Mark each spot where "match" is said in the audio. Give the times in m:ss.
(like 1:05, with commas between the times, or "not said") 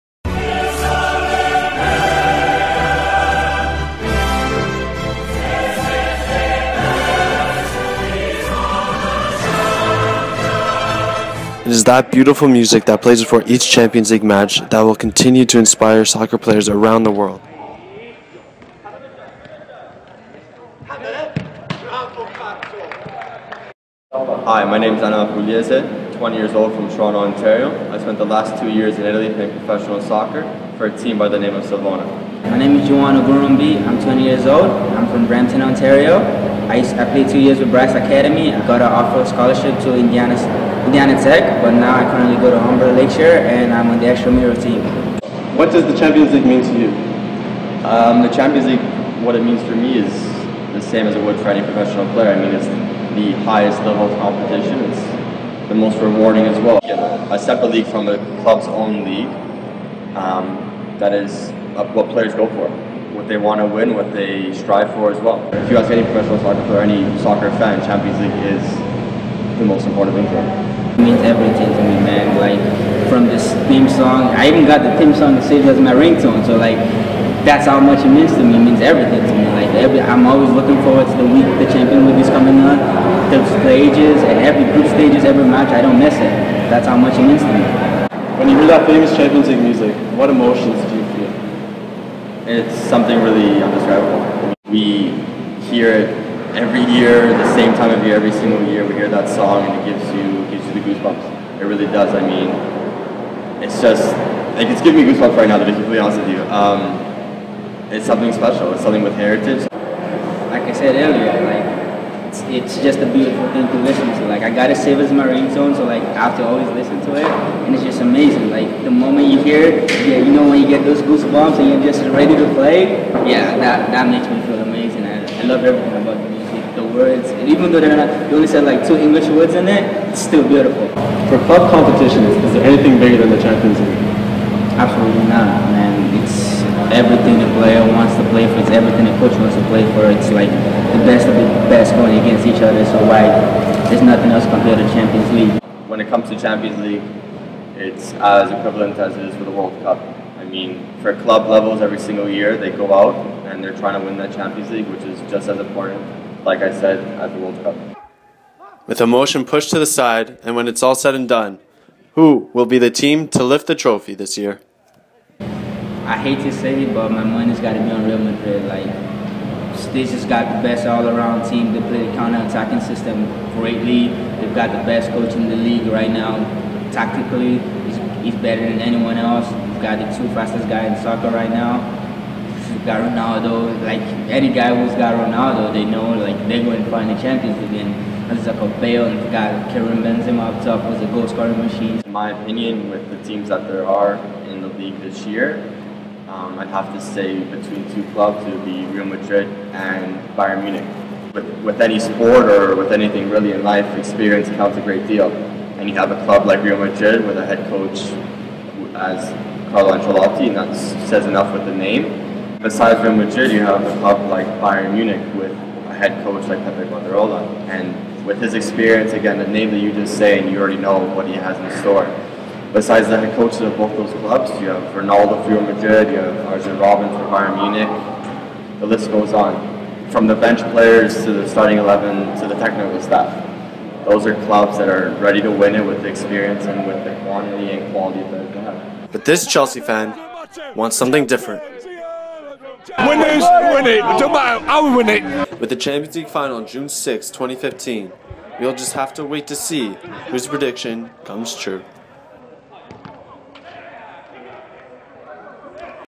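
0:14, 1:25.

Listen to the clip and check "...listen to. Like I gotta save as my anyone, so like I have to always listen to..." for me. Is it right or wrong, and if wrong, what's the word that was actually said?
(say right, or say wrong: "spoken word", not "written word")
wrong: "ringtone", not "anyone".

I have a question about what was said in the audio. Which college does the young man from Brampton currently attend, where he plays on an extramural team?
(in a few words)
Humber Lakeshore.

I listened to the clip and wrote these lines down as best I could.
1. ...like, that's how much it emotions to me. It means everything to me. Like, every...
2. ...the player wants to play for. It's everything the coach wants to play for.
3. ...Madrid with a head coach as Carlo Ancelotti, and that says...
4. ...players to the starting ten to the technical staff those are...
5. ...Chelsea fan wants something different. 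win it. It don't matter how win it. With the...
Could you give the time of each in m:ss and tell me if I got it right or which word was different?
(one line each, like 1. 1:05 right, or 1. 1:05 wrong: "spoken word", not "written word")
1. 1:16 wrong: "means", not "emotions"
2. 2:17 right
3. 3:26 right
4. 3:50 wrong: "eleven", not "ten"
5. 3:59 right.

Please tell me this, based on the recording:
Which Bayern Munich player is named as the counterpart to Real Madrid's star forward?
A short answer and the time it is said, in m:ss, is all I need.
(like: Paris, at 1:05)
Arjen Robben, at 3:46.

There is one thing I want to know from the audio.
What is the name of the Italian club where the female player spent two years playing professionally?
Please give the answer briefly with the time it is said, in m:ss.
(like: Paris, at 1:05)
Savona, at 0:31.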